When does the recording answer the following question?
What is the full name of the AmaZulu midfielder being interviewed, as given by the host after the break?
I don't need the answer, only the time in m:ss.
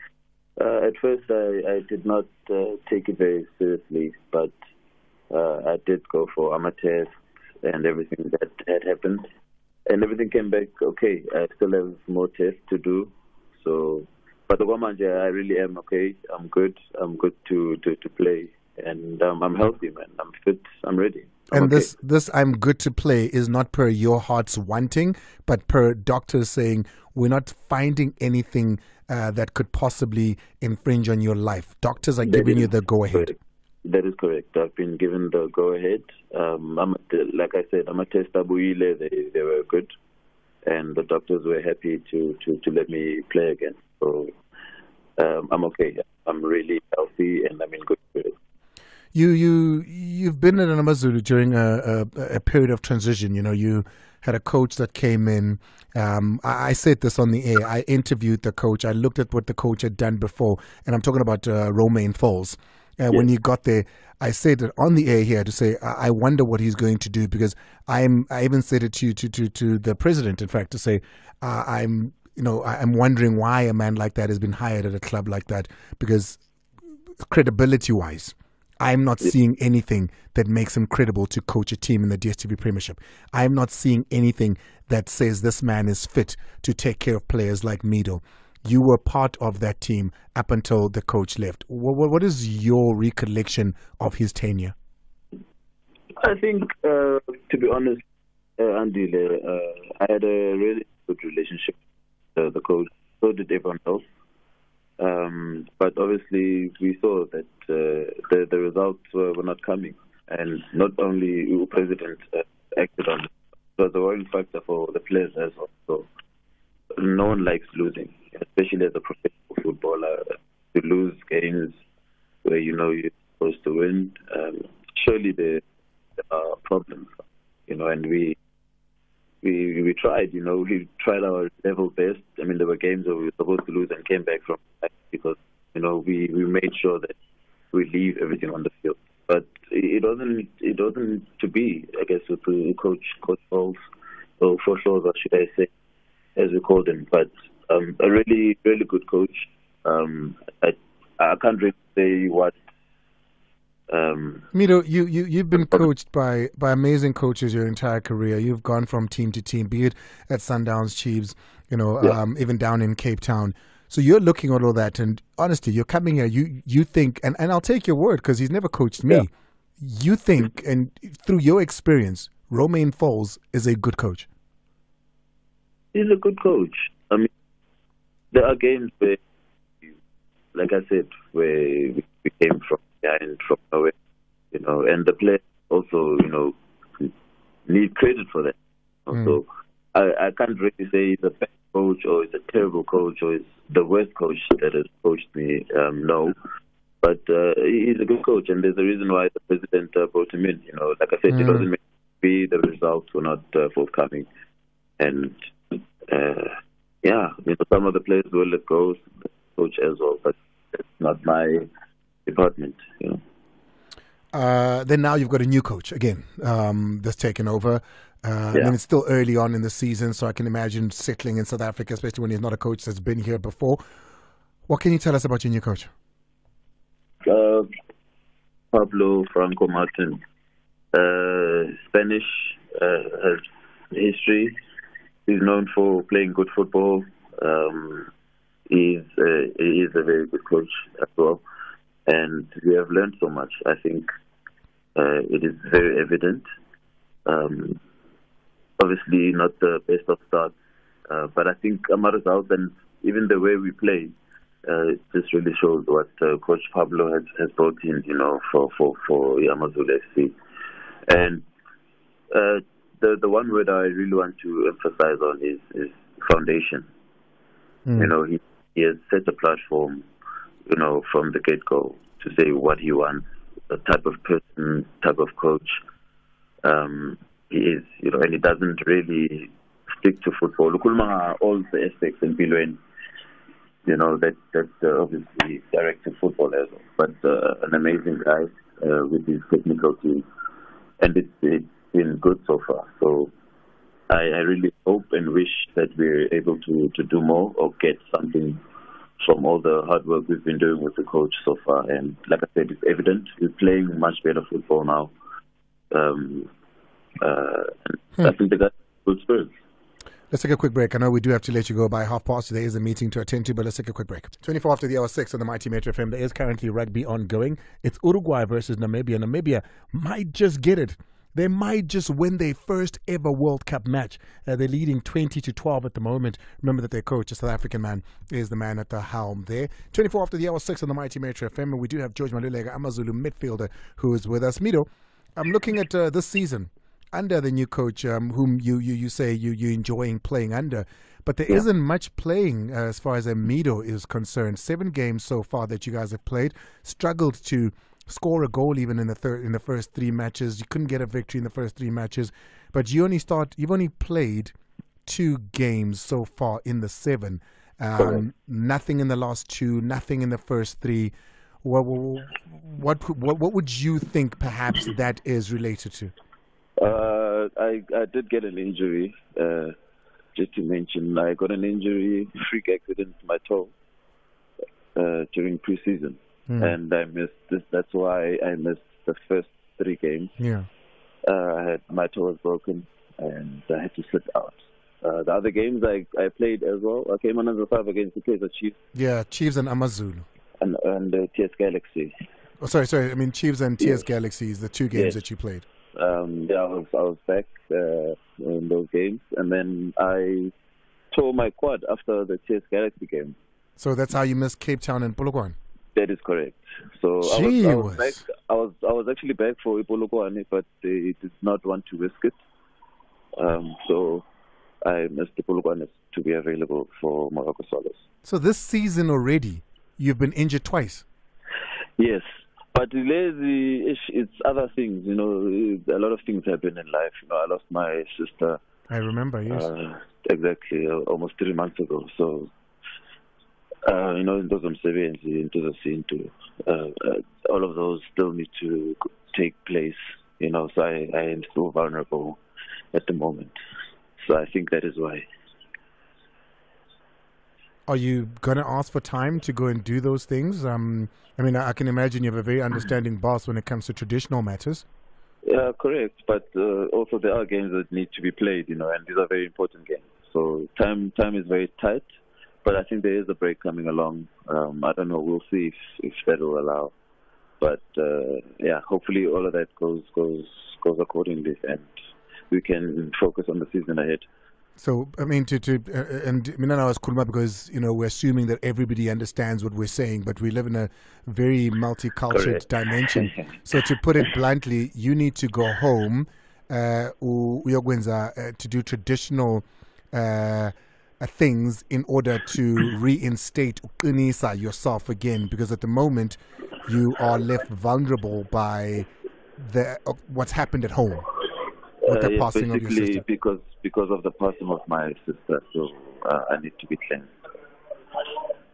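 5:32.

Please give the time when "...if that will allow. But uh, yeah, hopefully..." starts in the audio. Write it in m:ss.
7:46.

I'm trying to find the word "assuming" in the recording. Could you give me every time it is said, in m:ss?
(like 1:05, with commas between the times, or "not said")
7:58.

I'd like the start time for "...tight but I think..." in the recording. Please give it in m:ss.
7:41.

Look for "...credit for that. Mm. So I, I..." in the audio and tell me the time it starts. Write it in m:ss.
3:07.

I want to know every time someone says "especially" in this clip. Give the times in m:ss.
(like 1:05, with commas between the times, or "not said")
1:58, 3:41.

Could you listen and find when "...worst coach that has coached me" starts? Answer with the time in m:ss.
3:13.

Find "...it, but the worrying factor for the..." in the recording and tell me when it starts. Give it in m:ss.
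1:53.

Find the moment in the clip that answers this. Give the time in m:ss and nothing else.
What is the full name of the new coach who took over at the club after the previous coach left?
3:48.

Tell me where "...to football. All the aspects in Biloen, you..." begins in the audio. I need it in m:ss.
4:40.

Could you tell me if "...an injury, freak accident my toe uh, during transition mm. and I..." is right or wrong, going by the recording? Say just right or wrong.
wrong.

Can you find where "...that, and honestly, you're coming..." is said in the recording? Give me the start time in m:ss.
2:44.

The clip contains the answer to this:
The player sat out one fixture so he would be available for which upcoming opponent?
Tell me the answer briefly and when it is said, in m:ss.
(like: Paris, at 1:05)
Moroka Swallows, at 6:57.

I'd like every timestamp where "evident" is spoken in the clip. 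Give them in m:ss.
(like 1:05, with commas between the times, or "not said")
4:06, 5:02.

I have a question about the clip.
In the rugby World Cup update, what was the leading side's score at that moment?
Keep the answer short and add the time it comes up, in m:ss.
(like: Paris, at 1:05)
20 to 12, at 5:25.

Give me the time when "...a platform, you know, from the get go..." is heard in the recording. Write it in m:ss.
4:29.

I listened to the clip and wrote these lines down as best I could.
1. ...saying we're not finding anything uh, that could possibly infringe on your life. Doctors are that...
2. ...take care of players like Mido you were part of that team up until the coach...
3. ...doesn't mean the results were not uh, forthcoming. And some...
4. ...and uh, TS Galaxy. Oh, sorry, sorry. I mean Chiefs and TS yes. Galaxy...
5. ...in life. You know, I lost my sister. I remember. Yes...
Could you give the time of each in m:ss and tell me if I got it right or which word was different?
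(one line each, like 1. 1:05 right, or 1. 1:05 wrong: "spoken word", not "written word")
1. 0:26 right
2. 1:26 right
3. 3:21 right
4. 6:30 right
5. 7:06 right.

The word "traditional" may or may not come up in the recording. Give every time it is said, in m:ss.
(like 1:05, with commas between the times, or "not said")
7:33, 8:08.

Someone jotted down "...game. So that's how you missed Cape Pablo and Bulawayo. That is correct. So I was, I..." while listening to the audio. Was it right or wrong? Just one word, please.
wrong.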